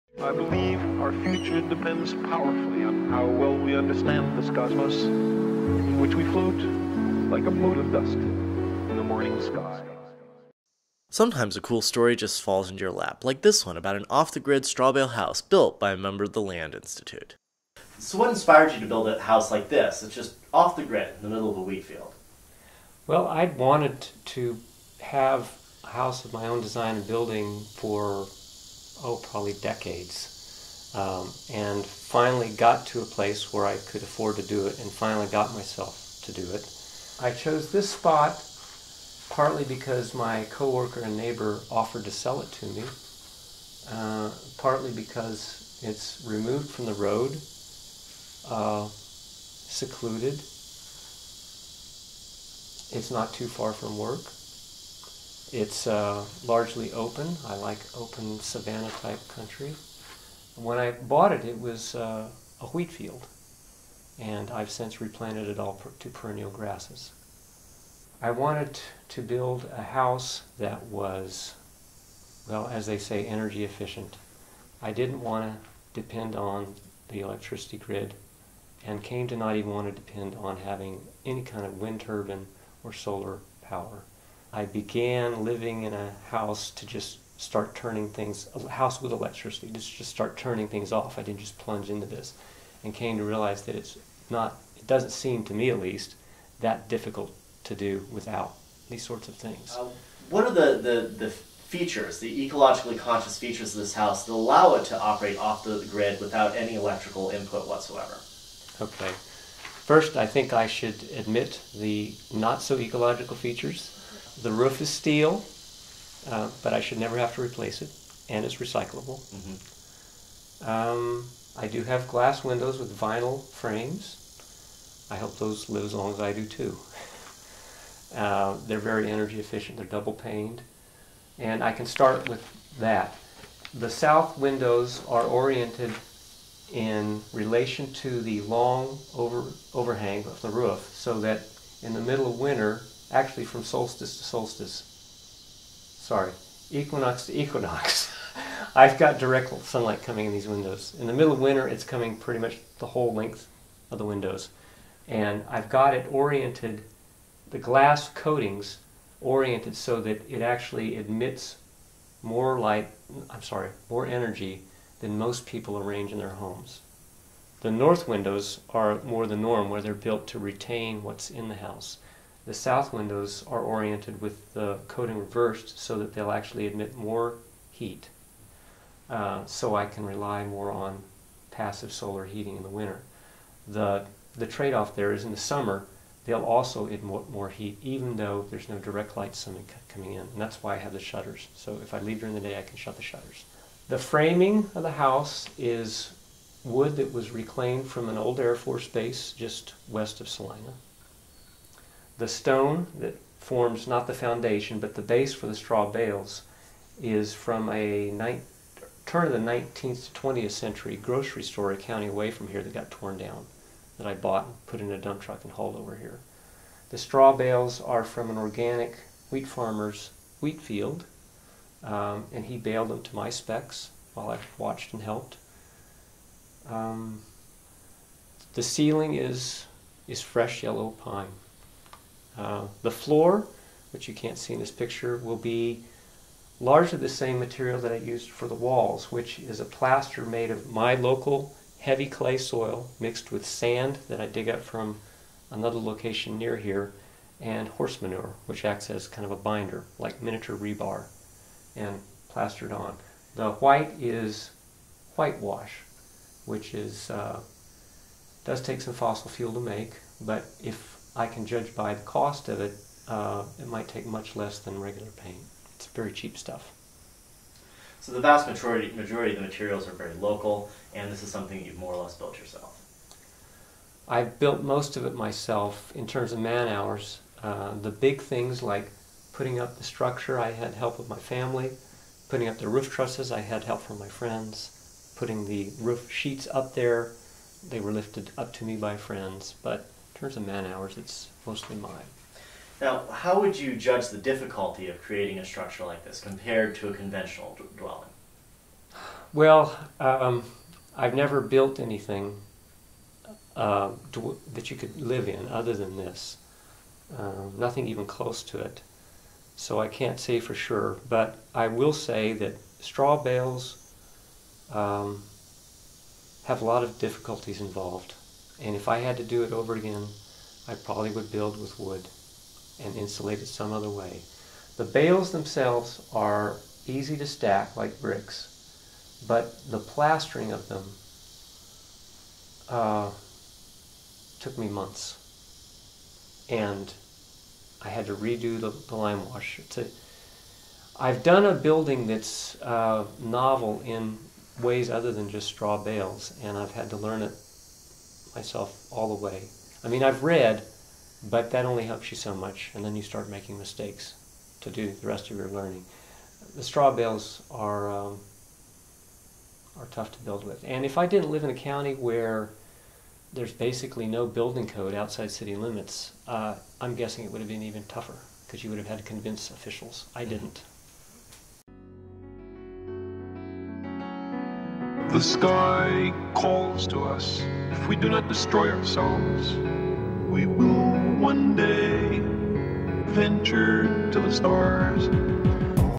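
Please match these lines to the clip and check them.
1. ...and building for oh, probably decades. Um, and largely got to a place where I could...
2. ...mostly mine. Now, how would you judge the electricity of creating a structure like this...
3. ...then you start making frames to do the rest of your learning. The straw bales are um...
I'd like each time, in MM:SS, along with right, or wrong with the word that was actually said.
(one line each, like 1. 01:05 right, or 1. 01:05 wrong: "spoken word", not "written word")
1. 00:26 wrong: "finally", not "largely"
2. 04:51 wrong: "difficulty", not "electricity"
3. 05:52 wrong: "mistakes", not "frames".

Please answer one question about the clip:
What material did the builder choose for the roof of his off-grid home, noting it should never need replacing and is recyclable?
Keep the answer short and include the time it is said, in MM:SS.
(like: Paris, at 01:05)
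steel, at 01:54.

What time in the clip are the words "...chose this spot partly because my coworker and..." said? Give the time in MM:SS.
00:37.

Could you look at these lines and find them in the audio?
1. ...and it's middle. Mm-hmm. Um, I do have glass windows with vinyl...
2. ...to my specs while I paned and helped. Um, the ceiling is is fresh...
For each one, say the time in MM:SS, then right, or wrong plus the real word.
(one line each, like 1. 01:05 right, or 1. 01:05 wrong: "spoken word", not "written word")
1. 01:58 wrong: "recyclable", not "middle"
2. 03:43 wrong: "watched", not "paned".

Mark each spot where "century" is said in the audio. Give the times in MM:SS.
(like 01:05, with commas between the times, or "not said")
03:30.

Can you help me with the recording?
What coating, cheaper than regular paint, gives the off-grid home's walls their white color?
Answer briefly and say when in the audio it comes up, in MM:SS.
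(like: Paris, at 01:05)
whitewash, at 04:15.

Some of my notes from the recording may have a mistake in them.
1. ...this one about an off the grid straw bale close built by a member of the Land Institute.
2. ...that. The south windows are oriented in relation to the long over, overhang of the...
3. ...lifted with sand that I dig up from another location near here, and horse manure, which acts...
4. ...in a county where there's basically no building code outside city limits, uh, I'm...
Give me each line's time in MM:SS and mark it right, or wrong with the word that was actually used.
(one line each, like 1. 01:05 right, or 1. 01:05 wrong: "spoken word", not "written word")
1. 00:13 wrong: "house", not "close"
2. 02:12 right
3. 04:02 wrong: "mixed", not "lifted"
4. 06:01 right.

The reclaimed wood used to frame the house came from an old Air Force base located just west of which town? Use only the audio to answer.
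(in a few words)
Salina.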